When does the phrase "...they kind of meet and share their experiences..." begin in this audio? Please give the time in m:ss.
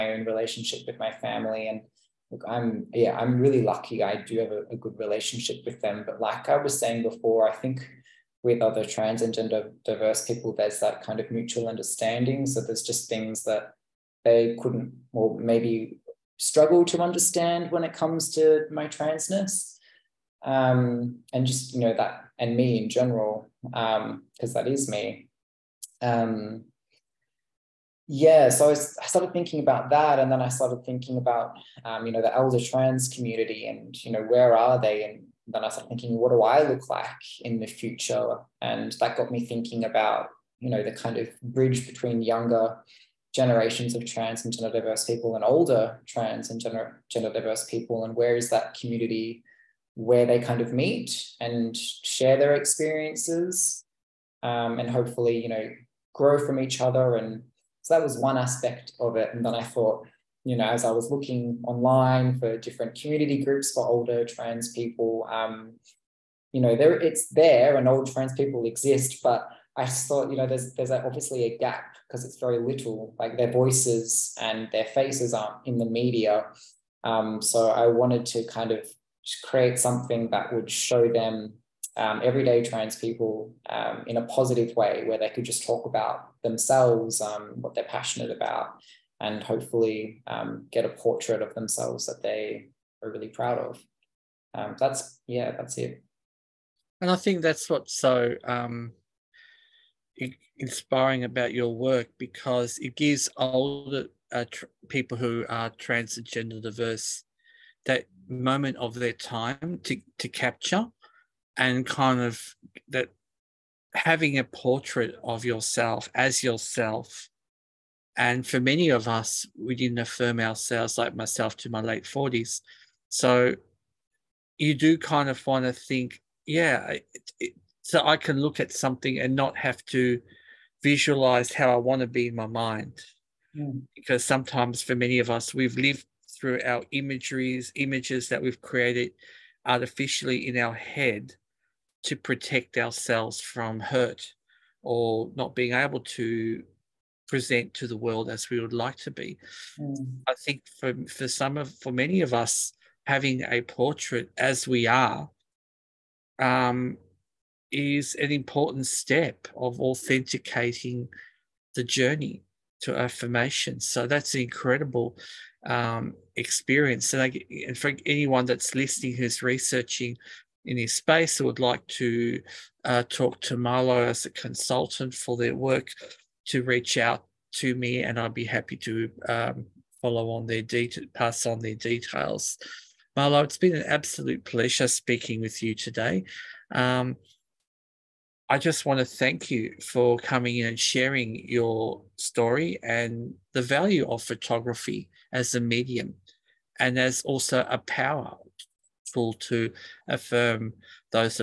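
0:50.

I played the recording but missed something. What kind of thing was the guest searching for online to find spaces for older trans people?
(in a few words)
community groups.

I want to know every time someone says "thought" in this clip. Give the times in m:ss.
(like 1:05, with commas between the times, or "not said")
0:59, 1:10.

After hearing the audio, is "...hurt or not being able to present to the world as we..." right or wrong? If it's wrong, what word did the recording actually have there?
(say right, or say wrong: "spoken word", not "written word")
right.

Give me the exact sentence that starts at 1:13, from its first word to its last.
Like their voices and their faces aren't in the media.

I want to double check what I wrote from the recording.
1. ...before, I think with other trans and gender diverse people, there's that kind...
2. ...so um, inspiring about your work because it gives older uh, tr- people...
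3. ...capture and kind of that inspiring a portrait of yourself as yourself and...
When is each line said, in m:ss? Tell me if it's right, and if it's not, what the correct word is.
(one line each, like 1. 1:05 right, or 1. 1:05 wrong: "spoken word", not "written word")
1. 0:07 right
2. 1:37 right
3. 1:50 wrong: "having", not "inspiring".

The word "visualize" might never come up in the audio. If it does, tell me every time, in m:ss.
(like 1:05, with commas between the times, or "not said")
2:10.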